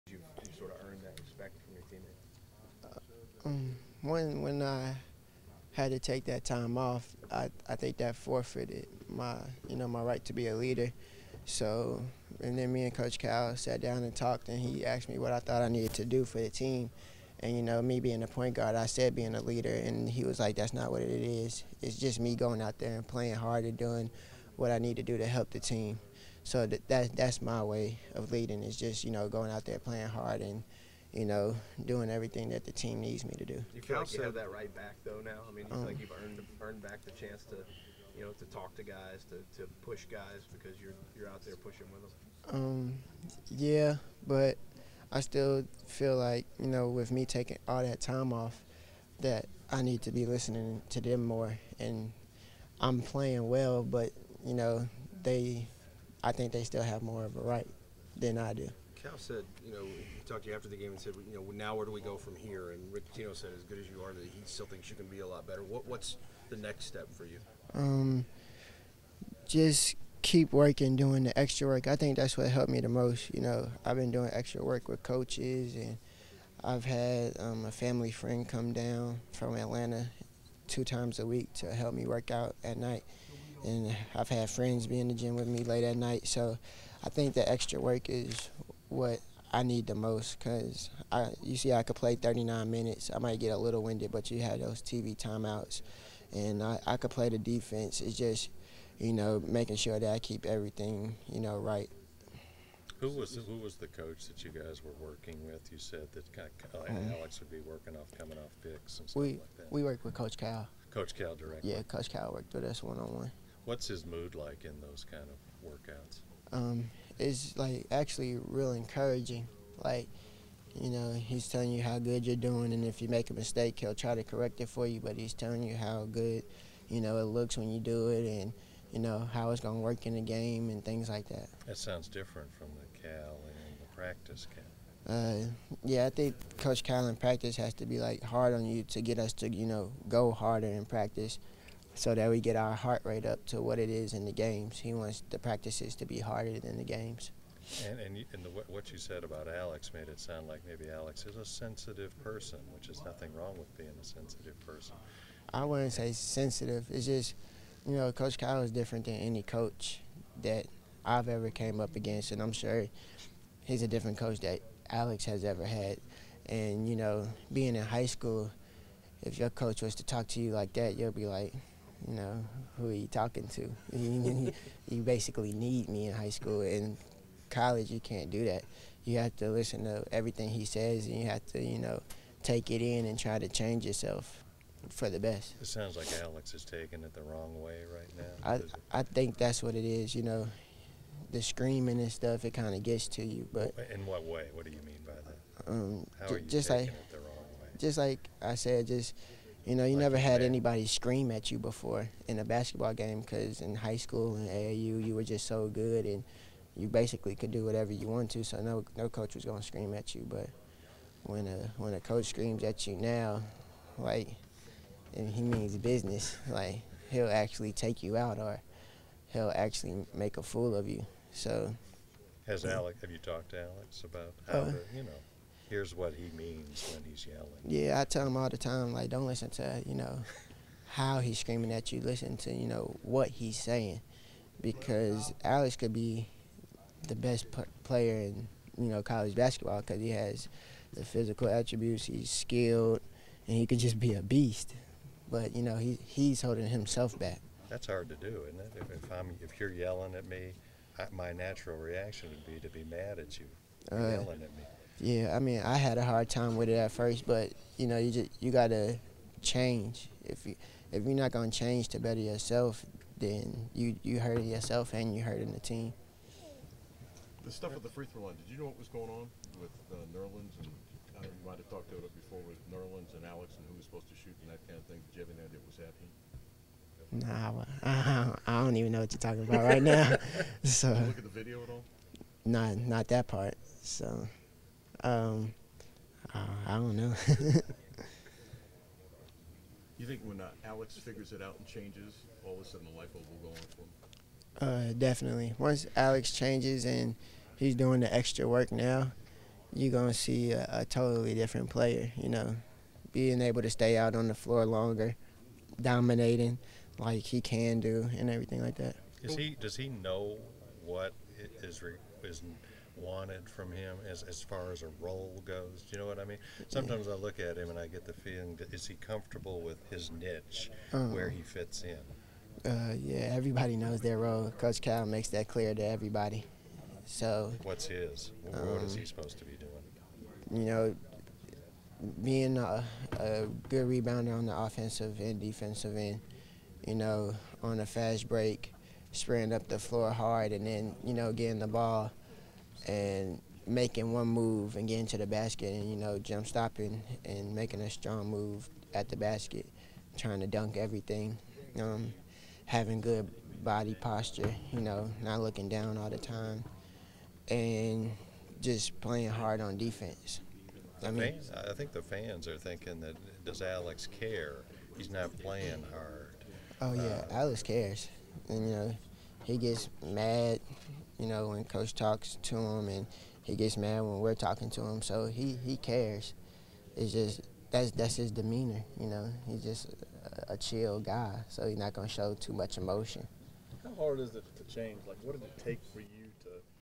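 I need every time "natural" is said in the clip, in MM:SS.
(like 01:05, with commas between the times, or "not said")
04:11.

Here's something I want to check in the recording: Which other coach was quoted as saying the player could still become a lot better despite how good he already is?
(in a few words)
Rick Pitino.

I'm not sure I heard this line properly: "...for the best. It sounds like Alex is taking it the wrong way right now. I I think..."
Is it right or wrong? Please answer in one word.
right.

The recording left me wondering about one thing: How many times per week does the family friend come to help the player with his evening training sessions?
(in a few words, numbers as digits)
2.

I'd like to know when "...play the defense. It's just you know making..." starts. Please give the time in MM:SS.
01:37.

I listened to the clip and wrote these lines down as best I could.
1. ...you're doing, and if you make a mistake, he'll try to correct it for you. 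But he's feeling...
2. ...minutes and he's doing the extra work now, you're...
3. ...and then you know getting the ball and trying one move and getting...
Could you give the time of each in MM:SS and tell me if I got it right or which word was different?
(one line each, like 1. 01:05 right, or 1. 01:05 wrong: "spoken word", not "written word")
1. 02:02 wrong: "telling", not "feeling"
2. 04:56 wrong: "changes", not "minutes"
3. 05:40 wrong: "making", not "trying".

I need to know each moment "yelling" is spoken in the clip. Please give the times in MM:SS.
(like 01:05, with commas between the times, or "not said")
03:47, 04:09, 04:13.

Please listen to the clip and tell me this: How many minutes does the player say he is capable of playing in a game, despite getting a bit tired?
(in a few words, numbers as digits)
39.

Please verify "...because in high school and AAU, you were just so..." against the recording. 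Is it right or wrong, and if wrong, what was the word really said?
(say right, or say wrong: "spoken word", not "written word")
right.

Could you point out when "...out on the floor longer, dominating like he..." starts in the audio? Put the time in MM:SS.
05:03.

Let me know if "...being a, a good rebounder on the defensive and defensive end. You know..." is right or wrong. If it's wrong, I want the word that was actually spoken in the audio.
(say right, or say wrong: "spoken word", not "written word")
wrong: "offensive", not "defensive".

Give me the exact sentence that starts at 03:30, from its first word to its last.
But when a when a coach screams at you now, like he means business.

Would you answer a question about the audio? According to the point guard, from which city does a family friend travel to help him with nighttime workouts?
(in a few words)
Atlanta.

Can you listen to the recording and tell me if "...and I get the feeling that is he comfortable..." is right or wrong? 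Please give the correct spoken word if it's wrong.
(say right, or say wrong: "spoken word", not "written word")
right.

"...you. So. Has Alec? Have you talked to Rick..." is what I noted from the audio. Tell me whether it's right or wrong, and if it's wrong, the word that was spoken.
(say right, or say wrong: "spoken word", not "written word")
wrong: "Alex", not "Rick".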